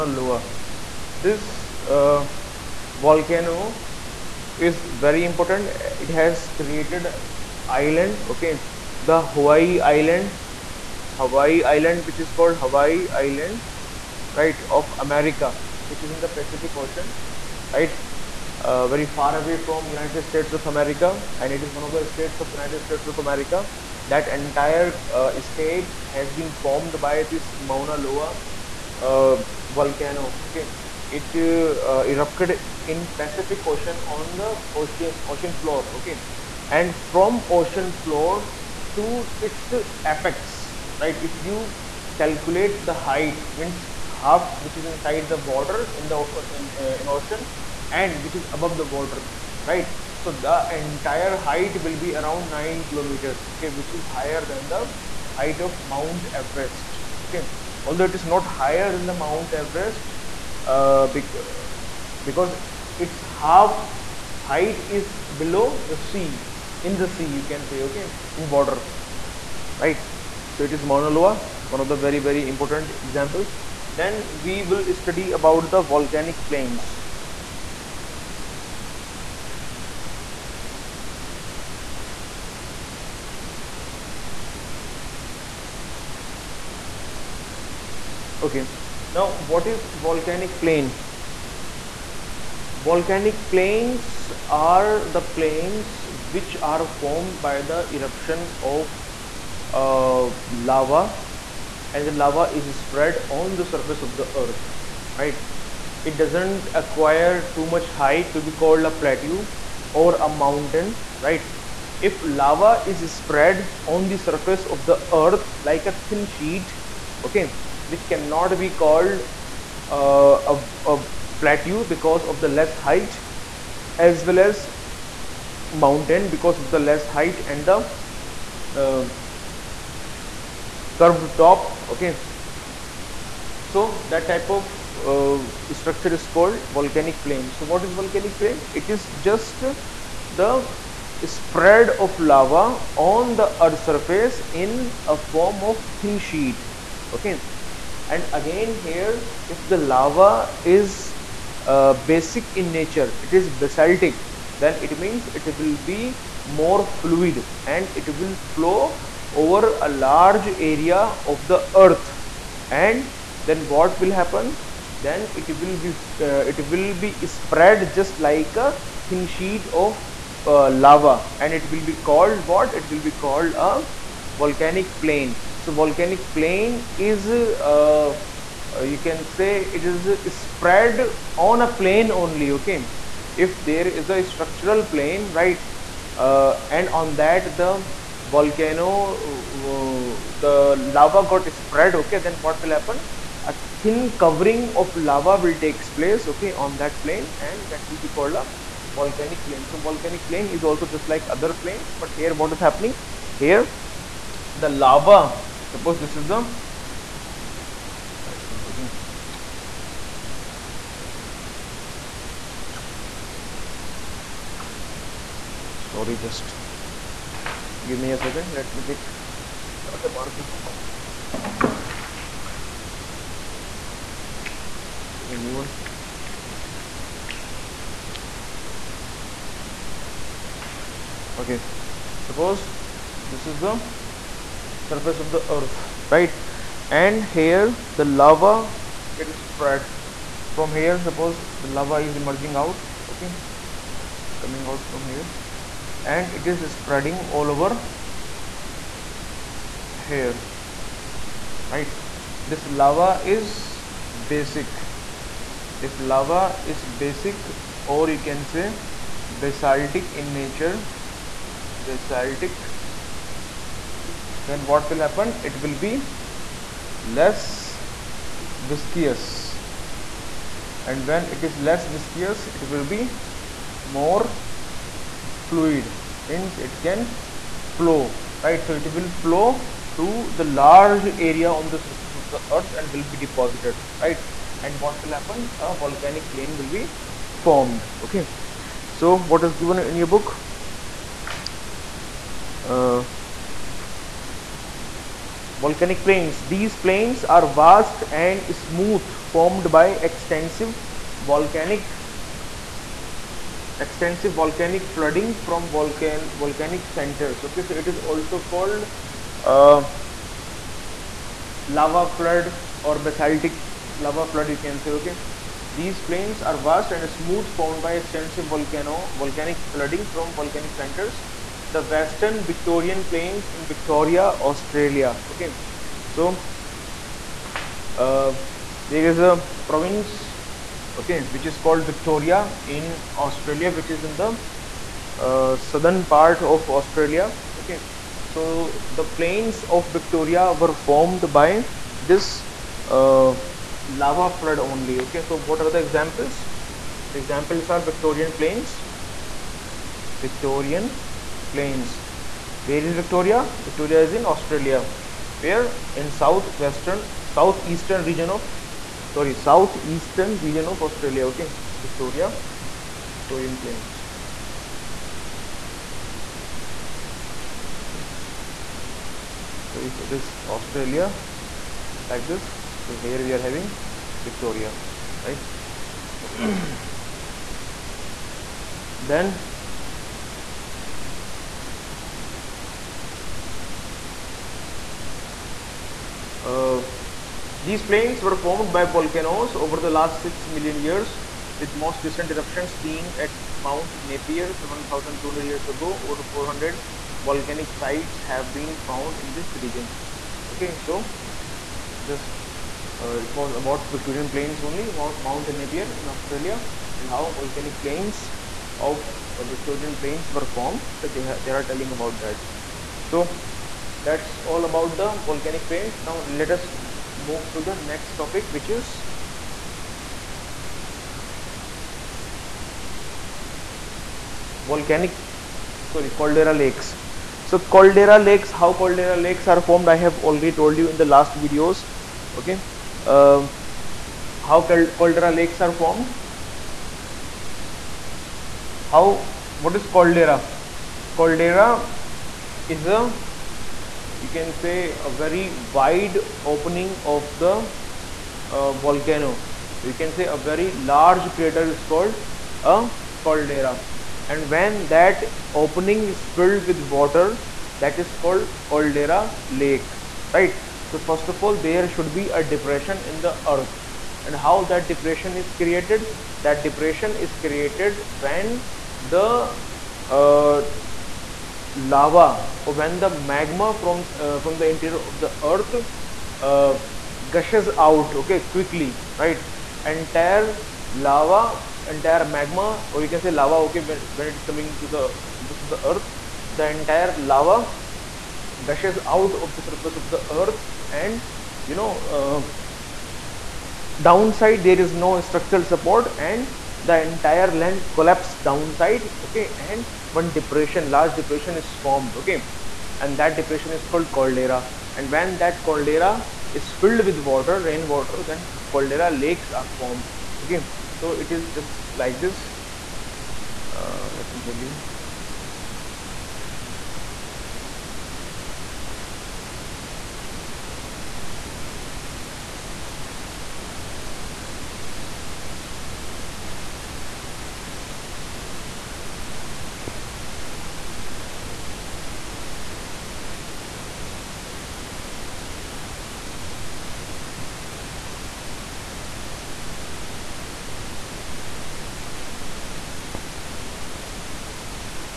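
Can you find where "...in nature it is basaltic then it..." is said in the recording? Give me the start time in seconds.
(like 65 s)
152 s.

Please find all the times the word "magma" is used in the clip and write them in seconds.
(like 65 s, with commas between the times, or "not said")
473 s, 482 s.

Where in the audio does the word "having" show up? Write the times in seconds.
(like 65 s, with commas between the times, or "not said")
373 s.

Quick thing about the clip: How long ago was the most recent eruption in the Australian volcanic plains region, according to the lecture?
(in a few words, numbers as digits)
7,200 years ago.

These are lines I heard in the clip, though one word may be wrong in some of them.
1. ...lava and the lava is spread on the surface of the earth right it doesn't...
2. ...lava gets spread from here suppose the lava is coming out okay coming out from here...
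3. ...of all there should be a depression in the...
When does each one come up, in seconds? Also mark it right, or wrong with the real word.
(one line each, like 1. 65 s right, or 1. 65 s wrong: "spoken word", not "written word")
1. 100 s right
2. 238 s wrong: "emerging", not "coming"
3. 461 s right.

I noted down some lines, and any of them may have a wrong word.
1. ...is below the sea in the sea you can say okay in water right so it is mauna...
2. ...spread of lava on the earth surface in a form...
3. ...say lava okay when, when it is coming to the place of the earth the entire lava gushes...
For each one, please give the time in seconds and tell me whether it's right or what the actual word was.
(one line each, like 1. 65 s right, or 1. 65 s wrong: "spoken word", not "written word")
1. 64 s right
2. 141 s right
3. 483 s wrong: "surface", not "place".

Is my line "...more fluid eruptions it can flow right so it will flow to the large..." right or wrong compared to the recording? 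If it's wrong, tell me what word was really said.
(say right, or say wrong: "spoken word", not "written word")
wrong: "means", not "eruptions".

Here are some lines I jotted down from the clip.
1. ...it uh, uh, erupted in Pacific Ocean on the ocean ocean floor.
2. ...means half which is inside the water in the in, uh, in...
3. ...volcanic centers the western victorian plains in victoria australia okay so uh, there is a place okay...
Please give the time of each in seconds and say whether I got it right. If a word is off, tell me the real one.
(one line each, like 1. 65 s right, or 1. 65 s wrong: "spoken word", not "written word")
1. 31 s right
2. 43 s right
3. 320 s wrong: "province", not "place".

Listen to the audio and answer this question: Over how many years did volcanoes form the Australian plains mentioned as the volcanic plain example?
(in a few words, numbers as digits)
6 million years.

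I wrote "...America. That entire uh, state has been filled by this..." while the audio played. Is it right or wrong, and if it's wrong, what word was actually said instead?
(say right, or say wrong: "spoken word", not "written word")
wrong: "formed", not "filled".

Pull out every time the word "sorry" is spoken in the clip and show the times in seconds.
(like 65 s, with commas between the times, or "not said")
215 s, 359 s, 425 s.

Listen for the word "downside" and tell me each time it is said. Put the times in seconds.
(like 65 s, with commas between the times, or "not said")
494 s, 498 s.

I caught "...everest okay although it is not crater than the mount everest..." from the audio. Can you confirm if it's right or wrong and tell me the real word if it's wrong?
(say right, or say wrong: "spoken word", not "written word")
wrong: "higher", not "crater".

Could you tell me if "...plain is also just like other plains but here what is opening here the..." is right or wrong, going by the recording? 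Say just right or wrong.
wrong.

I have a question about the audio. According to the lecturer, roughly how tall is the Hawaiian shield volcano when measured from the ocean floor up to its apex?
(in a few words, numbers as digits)
9 kilometers.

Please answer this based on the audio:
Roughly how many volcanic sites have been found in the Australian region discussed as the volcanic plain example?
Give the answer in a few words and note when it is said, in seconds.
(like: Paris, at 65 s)
Over 400, at 396 s.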